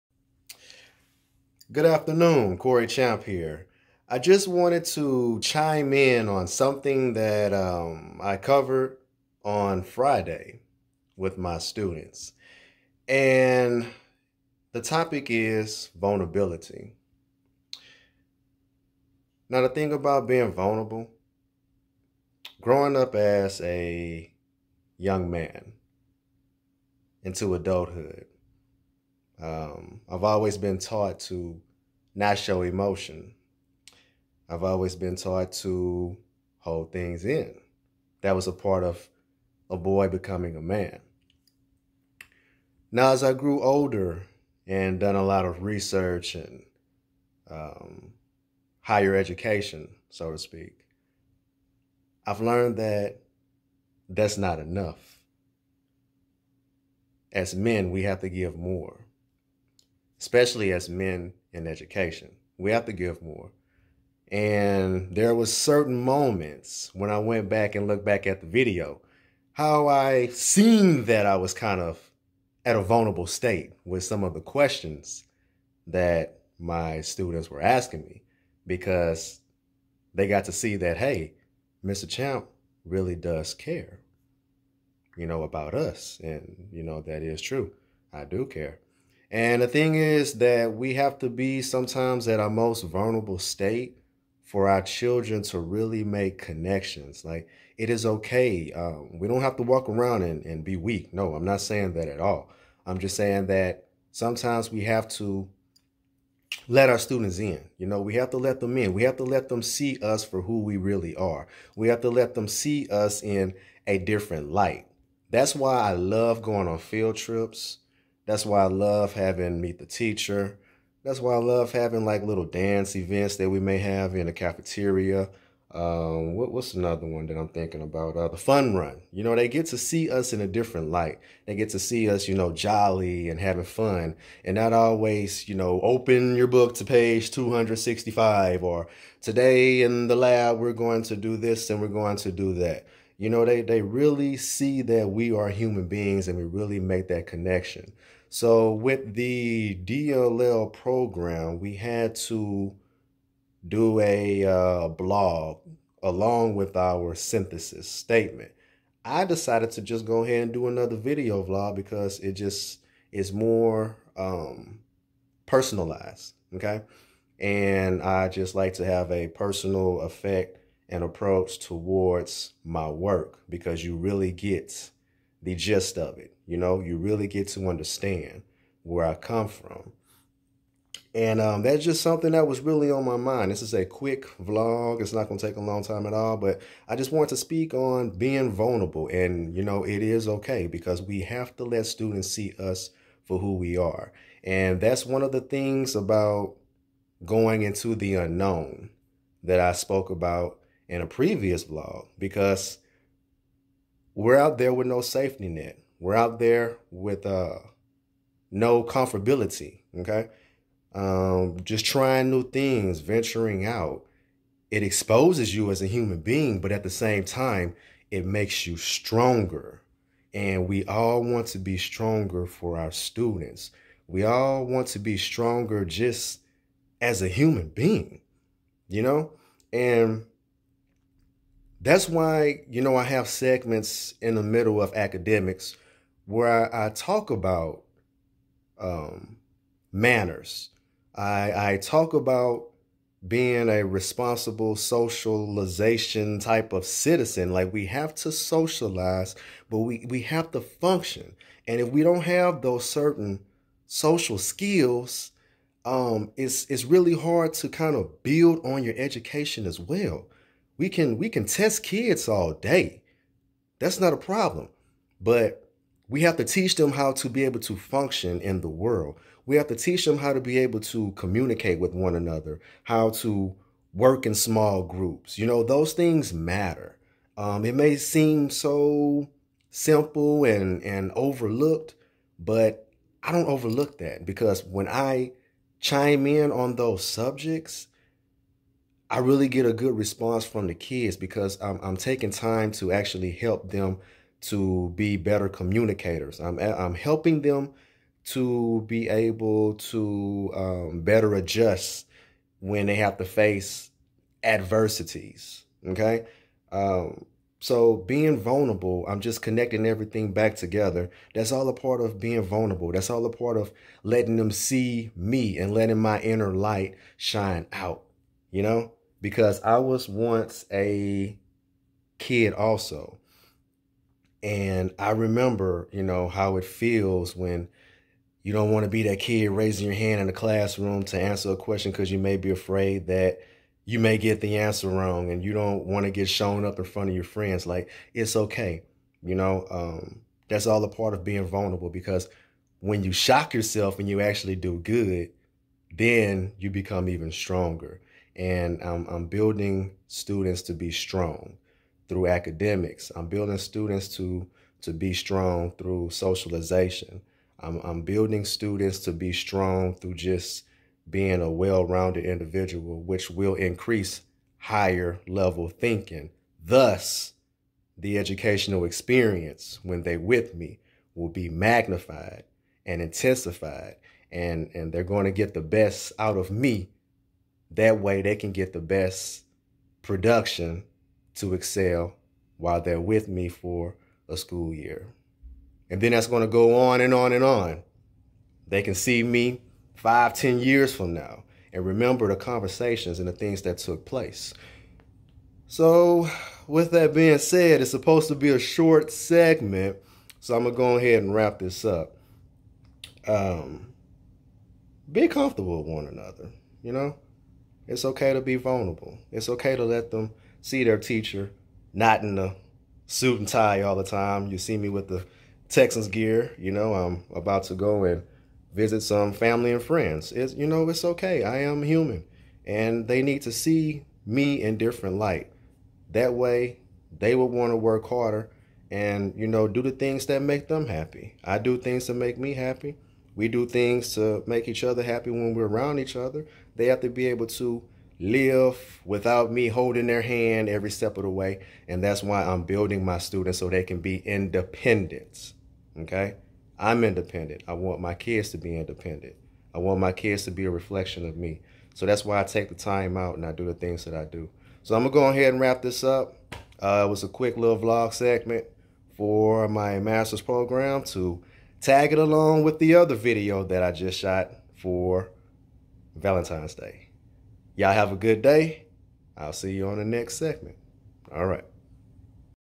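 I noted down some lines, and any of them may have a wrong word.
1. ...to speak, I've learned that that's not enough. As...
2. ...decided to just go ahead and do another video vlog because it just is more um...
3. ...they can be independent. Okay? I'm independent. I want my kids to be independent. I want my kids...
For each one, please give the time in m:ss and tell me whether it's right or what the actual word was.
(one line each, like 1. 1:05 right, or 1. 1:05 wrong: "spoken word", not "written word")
1. 0:50 right
2. 2:39 right
3. 7:23 right.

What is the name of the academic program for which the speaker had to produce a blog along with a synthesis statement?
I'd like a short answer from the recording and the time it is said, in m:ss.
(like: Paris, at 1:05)
DLL program, at 2:29.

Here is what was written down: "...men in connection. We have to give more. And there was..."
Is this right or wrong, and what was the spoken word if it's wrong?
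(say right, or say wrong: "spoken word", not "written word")
wrong: "education", not "connection".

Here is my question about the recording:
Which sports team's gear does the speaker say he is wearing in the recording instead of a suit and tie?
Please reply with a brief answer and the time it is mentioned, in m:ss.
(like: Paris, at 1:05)
Texans, at 6:55.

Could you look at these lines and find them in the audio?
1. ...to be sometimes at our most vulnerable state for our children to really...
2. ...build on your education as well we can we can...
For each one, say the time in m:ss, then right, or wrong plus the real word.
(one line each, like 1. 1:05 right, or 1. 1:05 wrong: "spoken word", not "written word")
1. 1:31 right
2. 4:18 right.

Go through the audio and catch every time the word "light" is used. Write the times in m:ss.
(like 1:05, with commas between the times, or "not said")
1:54, 2:10, 5:16, 7:05.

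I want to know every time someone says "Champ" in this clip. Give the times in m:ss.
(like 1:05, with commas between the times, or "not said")
0:02, 1:22.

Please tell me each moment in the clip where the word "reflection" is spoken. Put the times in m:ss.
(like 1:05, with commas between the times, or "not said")
7:30.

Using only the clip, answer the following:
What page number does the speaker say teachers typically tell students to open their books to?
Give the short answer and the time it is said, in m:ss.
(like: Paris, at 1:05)
265, at 2:17.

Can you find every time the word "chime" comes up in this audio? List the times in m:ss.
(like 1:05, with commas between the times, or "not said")
0:05, 4:45.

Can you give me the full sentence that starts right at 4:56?
I'm, I'm helping them to be able to um, better adjust when they have to face adversities.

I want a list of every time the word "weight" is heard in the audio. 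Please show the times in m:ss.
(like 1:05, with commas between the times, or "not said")
not said.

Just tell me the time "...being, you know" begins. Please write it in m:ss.
3:47.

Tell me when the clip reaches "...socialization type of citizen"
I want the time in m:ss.
4:04.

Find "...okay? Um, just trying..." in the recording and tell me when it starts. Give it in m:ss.
3:29.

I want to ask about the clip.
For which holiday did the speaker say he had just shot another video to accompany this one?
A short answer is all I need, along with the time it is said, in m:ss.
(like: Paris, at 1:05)
Valentine's Day, at 7:46.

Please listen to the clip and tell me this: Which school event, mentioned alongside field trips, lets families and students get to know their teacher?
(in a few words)
Meet the Teacher.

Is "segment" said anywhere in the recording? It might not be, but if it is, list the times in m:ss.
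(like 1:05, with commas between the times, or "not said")
3:53, 6:39, 7:38, 7:50.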